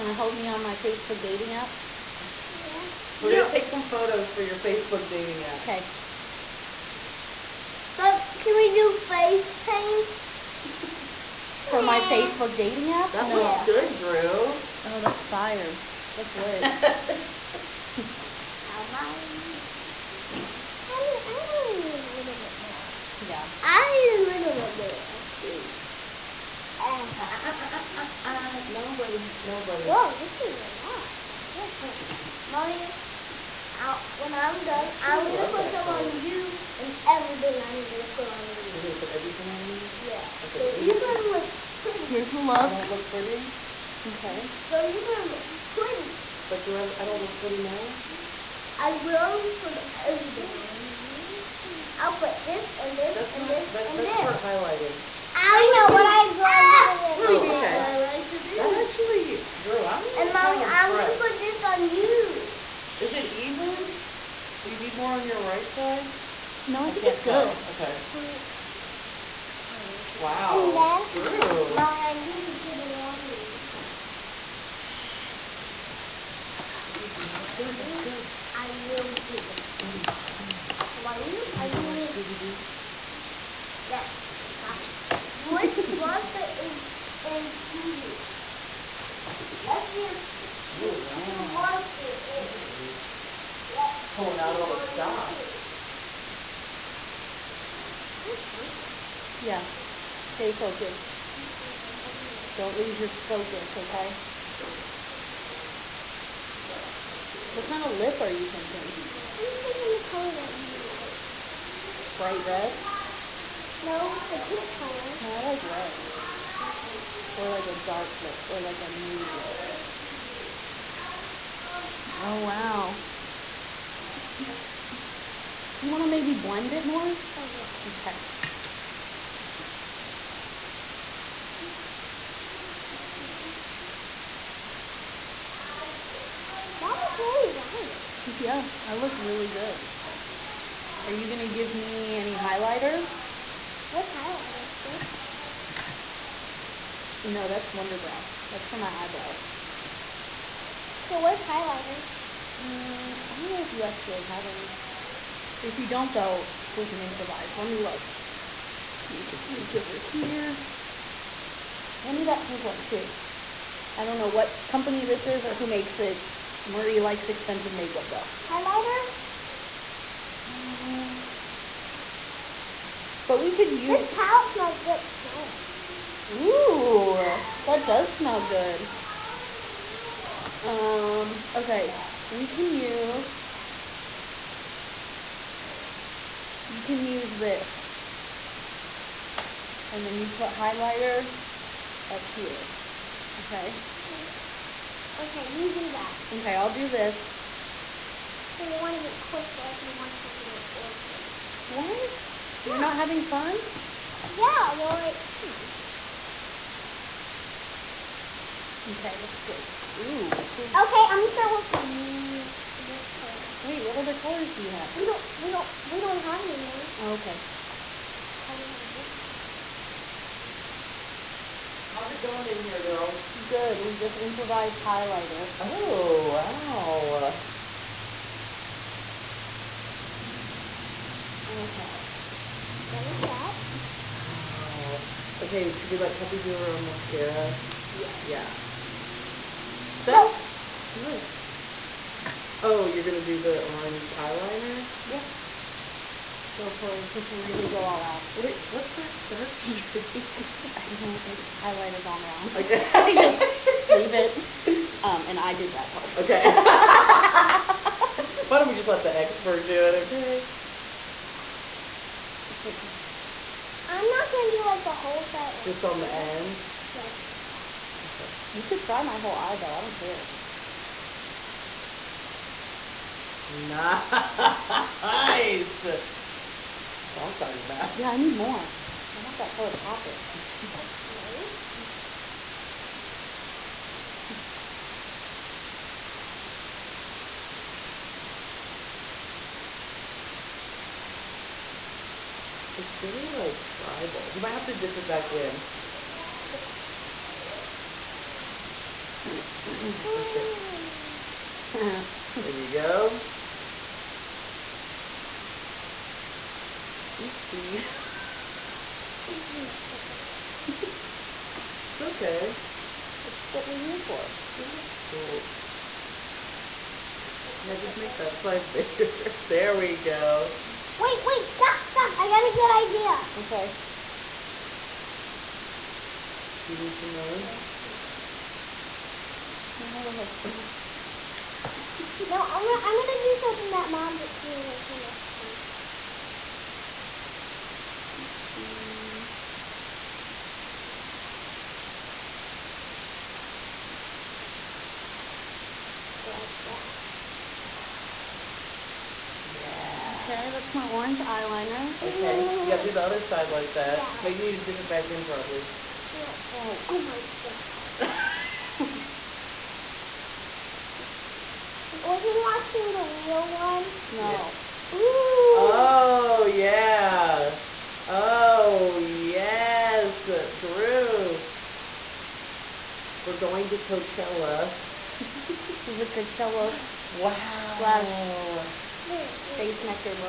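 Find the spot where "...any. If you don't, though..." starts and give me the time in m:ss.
2:34.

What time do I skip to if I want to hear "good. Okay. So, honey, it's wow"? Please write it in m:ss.
1:07.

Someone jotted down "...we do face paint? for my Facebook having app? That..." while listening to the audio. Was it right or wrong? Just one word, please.
wrong.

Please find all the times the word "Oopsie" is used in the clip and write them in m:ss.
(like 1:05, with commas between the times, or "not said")
5:07, 5:38.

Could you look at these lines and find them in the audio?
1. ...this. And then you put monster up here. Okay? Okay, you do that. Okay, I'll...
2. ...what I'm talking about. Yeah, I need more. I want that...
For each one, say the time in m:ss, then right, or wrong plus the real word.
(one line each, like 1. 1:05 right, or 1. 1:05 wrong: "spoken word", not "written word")
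1. 3:07 wrong: "highlighter", not "monster"
2. 4:37 right.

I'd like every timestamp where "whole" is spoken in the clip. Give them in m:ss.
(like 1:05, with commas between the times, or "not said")
4:24, 4:29.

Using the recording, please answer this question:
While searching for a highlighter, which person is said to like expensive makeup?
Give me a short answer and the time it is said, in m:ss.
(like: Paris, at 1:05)
Marie, at 2:46.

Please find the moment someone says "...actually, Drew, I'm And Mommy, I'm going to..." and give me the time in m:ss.
0:58.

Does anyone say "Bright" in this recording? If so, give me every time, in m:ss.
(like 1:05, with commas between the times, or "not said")
1:52.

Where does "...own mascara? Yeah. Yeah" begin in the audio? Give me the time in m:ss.
3:56.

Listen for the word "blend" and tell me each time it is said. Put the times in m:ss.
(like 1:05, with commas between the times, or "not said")
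2:06.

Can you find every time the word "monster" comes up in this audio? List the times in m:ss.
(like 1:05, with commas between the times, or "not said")
1:25, 1:31.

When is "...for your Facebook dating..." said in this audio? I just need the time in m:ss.
0:04.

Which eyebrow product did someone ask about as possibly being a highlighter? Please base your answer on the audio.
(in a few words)
Wunderbrow.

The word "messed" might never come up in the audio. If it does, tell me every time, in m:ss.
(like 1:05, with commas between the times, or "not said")
5:09, 5:34.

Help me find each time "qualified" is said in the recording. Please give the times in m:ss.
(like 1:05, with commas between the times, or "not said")
not said.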